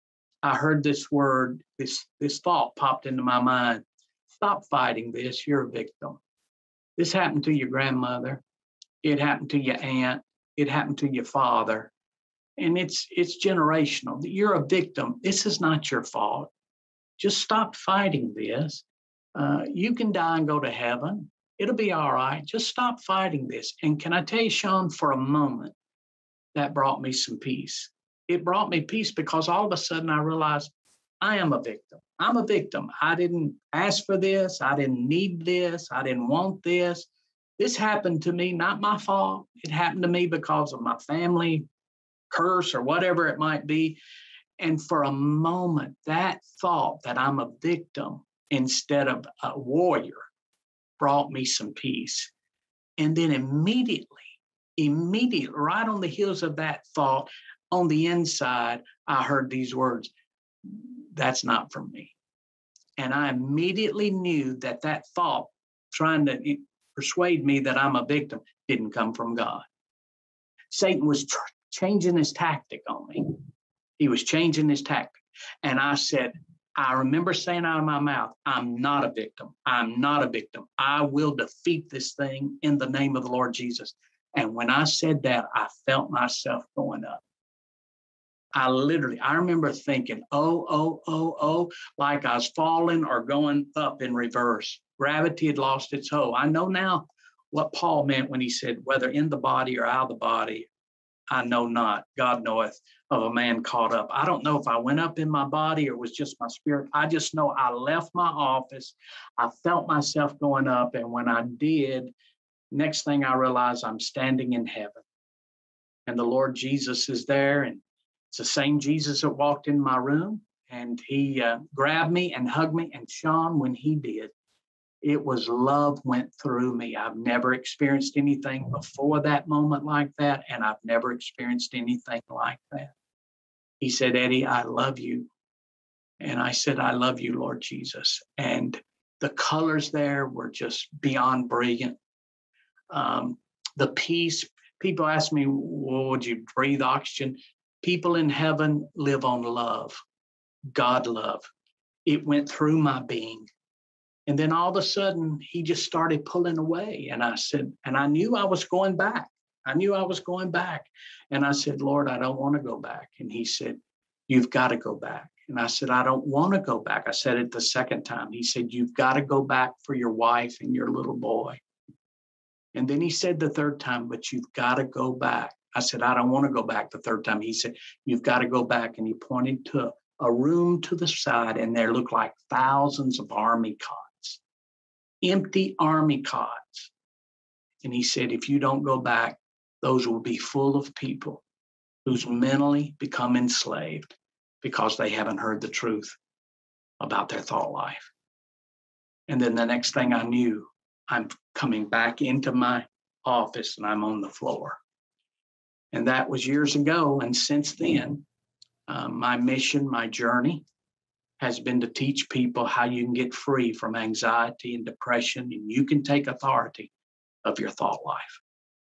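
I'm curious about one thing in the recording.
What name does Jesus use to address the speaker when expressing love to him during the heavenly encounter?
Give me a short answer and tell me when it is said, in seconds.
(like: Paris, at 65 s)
Eddie, at 134 s.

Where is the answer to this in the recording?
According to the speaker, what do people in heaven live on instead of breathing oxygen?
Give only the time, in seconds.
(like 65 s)
150 s.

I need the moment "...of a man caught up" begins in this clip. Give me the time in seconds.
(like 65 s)
103 s.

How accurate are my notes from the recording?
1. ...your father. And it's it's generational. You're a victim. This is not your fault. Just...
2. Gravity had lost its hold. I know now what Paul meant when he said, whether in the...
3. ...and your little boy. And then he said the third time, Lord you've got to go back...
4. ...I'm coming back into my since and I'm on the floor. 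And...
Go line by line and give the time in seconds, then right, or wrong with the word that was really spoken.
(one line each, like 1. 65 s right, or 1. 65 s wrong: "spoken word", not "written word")
1. 11 s right
2. 94 s right
3. 170 s wrong: "But", not "Lord"
4. 201 s wrong: "office", not "since".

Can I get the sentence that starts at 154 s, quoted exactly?
And then all of a sudden, he just started pulling away.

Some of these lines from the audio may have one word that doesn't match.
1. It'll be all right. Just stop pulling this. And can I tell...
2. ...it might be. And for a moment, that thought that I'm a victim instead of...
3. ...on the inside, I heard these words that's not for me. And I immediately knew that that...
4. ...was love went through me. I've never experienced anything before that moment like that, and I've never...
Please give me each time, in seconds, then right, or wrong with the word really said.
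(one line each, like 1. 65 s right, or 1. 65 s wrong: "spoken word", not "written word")
1. 21 s wrong: "fighting", not "pulling"
2. 43 s right
3. 57 s right
4. 125 s right.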